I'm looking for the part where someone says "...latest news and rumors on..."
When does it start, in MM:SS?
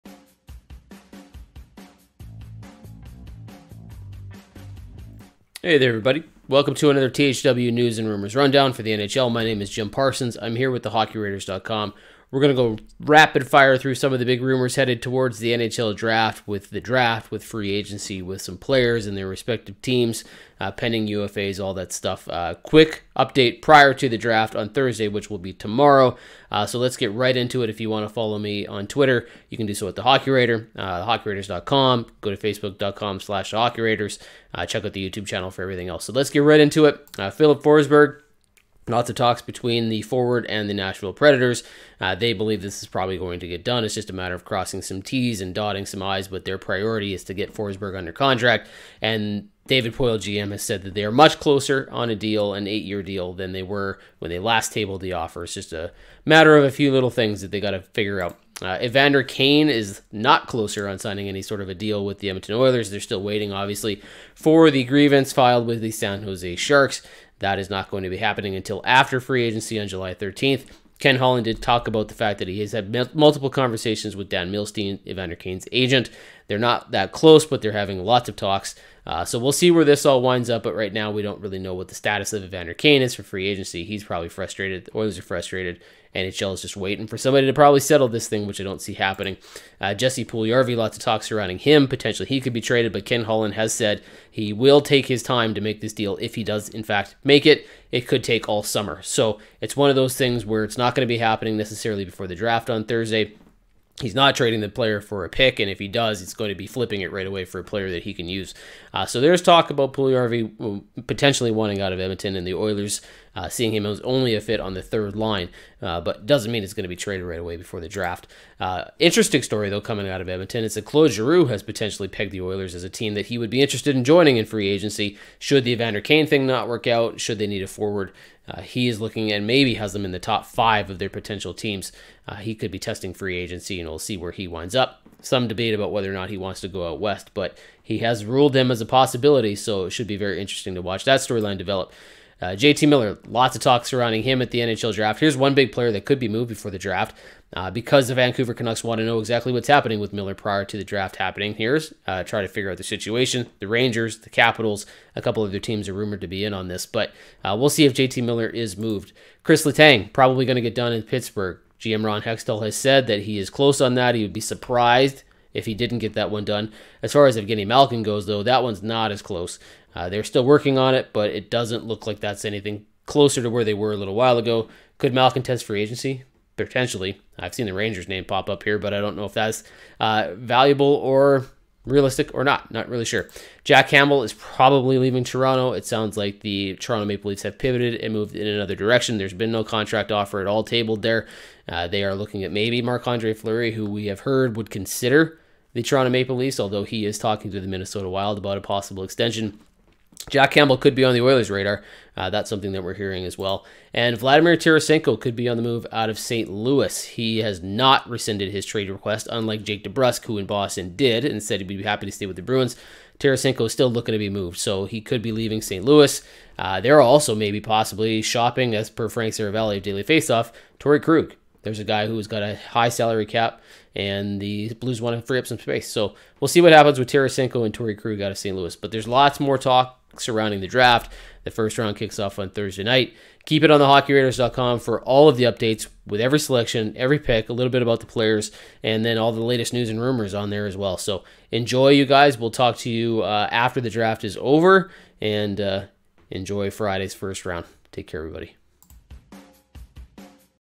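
03:59.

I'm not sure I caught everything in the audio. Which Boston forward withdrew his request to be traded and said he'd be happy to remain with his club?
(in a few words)
Jake DeBrusk.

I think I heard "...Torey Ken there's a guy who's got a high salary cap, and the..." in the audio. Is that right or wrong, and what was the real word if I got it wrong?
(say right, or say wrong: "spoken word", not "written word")
wrong: "Krug", not "Ken".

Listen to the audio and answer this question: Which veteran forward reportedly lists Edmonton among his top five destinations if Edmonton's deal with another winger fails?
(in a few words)
Claude Giroux.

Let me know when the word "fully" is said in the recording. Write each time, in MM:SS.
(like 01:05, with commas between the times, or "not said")
not said.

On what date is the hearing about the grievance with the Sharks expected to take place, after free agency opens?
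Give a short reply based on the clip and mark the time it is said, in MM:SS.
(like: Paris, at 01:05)
July 13, at 01:09.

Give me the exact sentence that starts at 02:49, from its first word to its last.
Uh, they're still working on it, but it doesn't look like that's anything closer to where they were a little while ago.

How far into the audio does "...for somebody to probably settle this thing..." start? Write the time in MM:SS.
01:27.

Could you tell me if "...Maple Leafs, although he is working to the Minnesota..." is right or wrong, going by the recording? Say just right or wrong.
wrong.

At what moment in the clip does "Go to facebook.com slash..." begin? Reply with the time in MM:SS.
00:32.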